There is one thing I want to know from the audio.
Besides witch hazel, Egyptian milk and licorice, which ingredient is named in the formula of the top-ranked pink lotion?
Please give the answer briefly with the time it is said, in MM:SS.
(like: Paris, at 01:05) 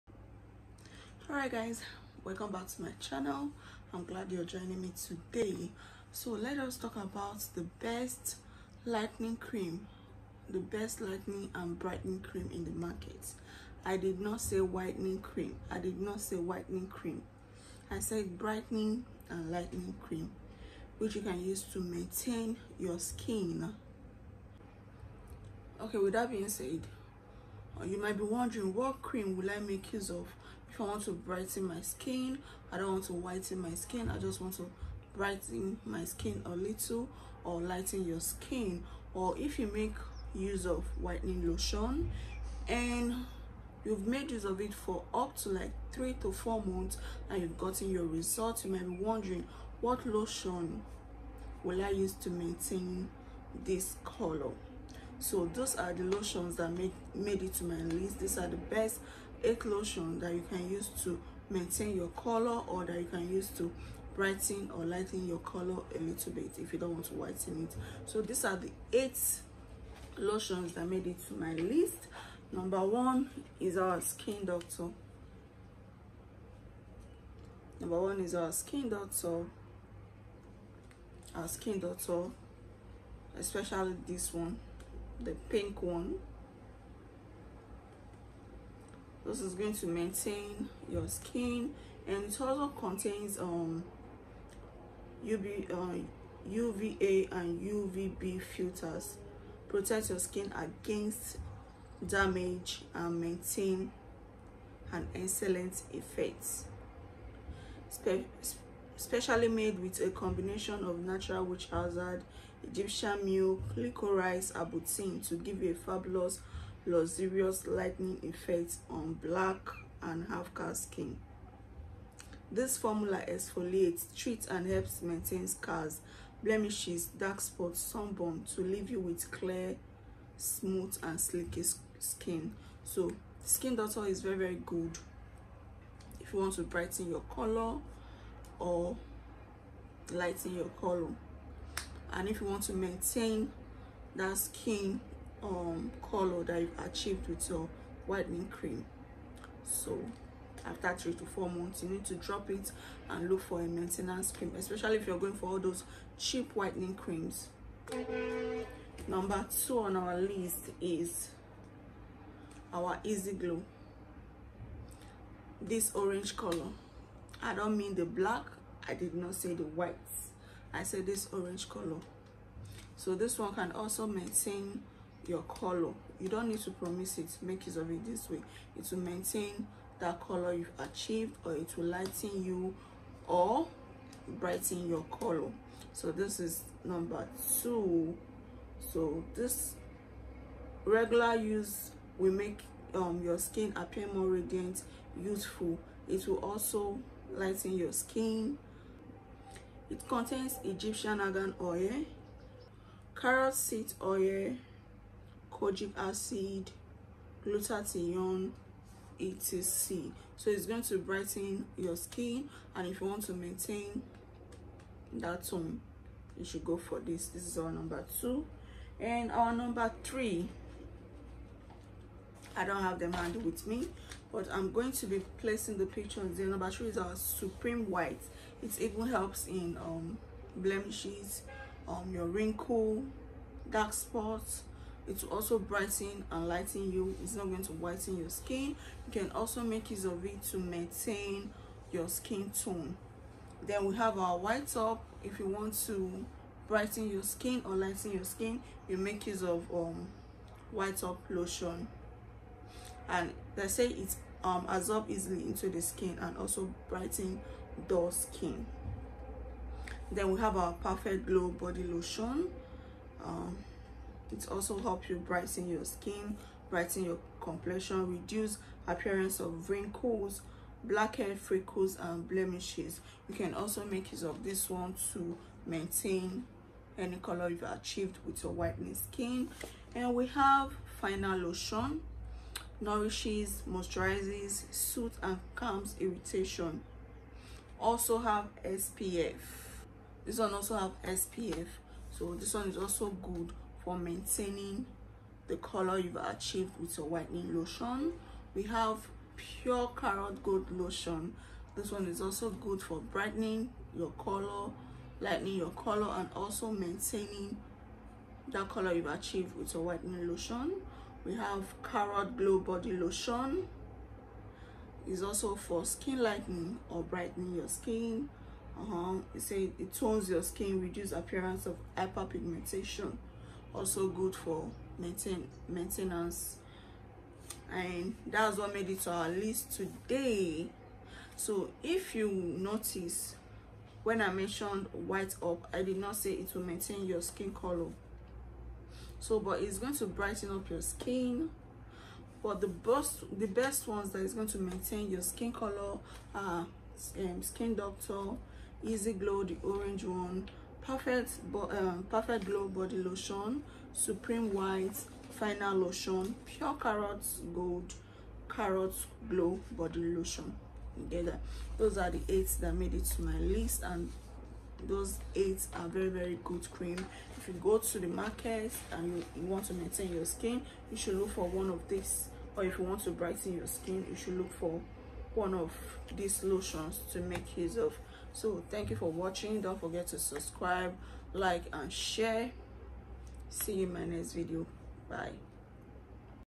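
arbutin, at 01:54.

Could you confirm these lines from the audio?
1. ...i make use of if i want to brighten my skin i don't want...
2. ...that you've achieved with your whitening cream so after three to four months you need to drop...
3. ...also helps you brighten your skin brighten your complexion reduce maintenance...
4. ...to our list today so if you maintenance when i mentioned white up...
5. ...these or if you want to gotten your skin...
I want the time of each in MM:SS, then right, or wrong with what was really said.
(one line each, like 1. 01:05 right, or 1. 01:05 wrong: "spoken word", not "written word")
1. 00:29 right
2. 02:26 right
3. 04:24 wrong: "appearance", not "maintenance"
4. 05:28 wrong: "notice", not "maintenance"
5. 06:11 wrong: "brighten", not "gotten".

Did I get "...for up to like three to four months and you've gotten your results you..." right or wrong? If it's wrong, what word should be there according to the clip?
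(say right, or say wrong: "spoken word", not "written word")
right.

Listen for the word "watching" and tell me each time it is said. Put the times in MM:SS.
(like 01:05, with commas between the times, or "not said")
06:19.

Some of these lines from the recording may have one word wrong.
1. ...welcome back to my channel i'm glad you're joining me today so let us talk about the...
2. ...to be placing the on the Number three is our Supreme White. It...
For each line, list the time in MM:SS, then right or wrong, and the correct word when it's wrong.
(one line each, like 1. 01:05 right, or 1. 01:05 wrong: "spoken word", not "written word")
1. 00:02 right
2. 03:44 right.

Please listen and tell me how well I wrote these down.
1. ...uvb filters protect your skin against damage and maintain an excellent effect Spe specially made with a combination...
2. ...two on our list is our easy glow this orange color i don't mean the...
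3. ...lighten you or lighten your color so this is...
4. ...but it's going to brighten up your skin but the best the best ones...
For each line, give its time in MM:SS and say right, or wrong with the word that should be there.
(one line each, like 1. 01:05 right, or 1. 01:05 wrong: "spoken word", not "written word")
1. 01:37 right
2. 02:39 right
3. 03:01 wrong: "brighten", not "lighten"
4. 05:39 right.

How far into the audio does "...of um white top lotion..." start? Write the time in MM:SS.
04:09.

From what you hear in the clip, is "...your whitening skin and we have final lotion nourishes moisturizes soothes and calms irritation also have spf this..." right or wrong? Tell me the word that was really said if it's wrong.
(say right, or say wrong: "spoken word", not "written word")
right.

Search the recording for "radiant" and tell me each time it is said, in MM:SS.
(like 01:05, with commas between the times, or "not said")
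03:14.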